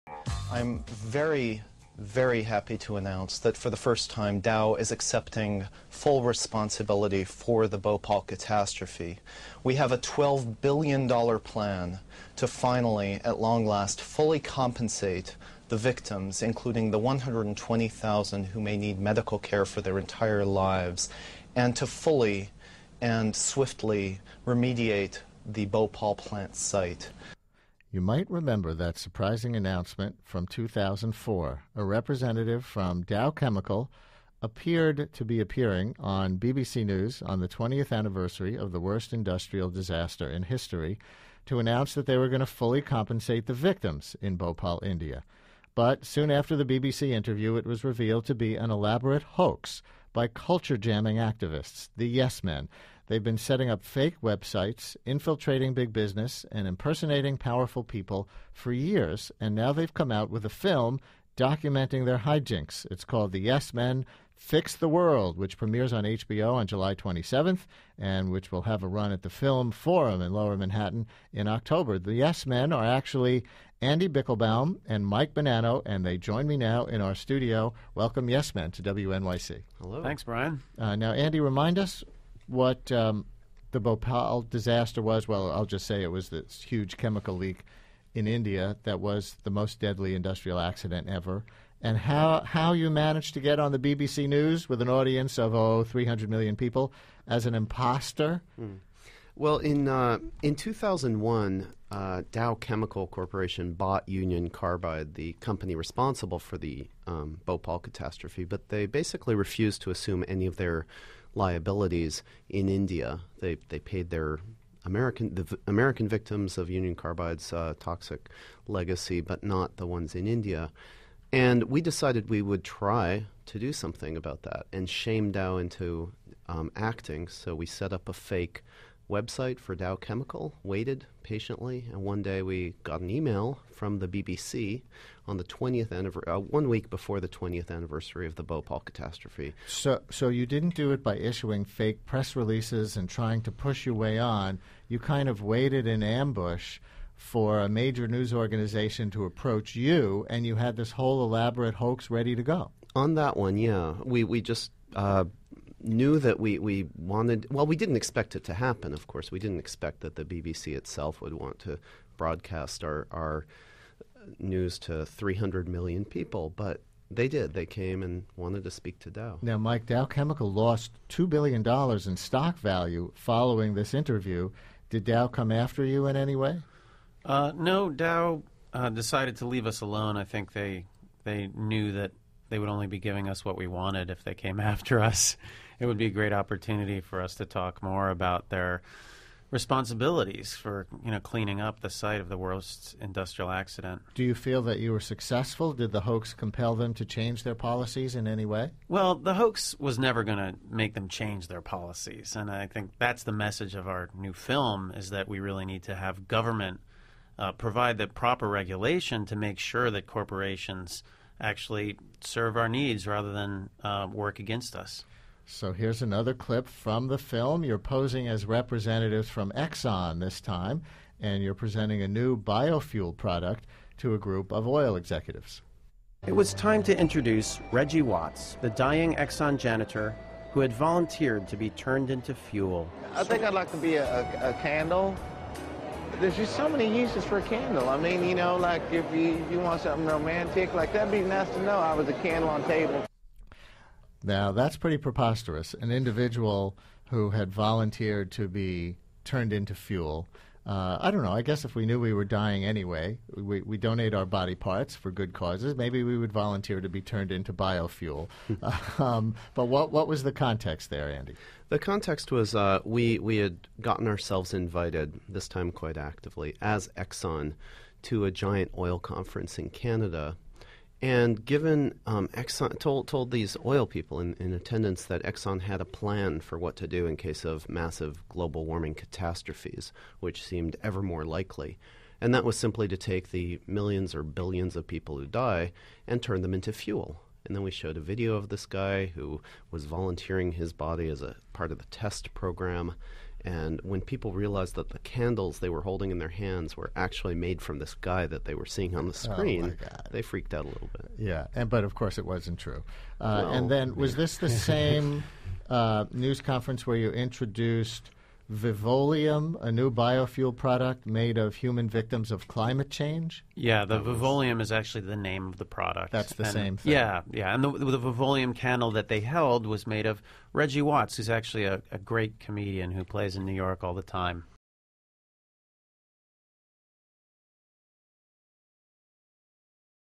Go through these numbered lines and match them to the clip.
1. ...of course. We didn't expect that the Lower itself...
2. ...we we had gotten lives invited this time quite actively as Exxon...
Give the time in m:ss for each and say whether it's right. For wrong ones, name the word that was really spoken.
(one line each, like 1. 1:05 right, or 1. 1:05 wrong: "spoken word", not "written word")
1. 2:38 wrong: "BBC", not "Lower"
2. 4:22 wrong: "ourselves", not "lives".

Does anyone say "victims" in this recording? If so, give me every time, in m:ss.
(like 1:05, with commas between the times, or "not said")
0:15, 0:43, 1:56, 5:11.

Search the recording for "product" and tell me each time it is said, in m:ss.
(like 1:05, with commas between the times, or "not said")
3:43, 5:10, 5:15.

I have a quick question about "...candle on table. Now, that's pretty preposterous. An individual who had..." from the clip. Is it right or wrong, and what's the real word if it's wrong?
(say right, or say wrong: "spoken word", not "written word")
right.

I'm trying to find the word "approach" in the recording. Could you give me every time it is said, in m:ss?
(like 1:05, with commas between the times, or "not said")
2:29.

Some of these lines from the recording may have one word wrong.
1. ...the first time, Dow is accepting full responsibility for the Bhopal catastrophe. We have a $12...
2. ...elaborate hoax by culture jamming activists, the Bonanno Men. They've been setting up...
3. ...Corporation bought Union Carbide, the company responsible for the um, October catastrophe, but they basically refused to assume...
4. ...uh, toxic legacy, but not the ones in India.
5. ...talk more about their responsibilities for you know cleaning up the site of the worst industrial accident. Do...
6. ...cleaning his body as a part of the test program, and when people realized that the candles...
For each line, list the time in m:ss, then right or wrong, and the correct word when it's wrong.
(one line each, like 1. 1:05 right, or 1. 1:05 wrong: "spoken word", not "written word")
1. 0:03 right
2. 0:48 wrong: "Yes", not "Bonanno"
3. 1:43 wrong: "Bhopal", not "October"
4. 1:57 right
5. 3:07 right
6. 4:49 wrong: "volunteering", not "cleaning".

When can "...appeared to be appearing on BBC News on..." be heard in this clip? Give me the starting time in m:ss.
0:34.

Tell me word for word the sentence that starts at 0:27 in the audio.
You might remember that surprising announcement from 2004.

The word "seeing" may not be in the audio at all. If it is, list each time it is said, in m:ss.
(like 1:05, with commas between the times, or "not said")
4:58.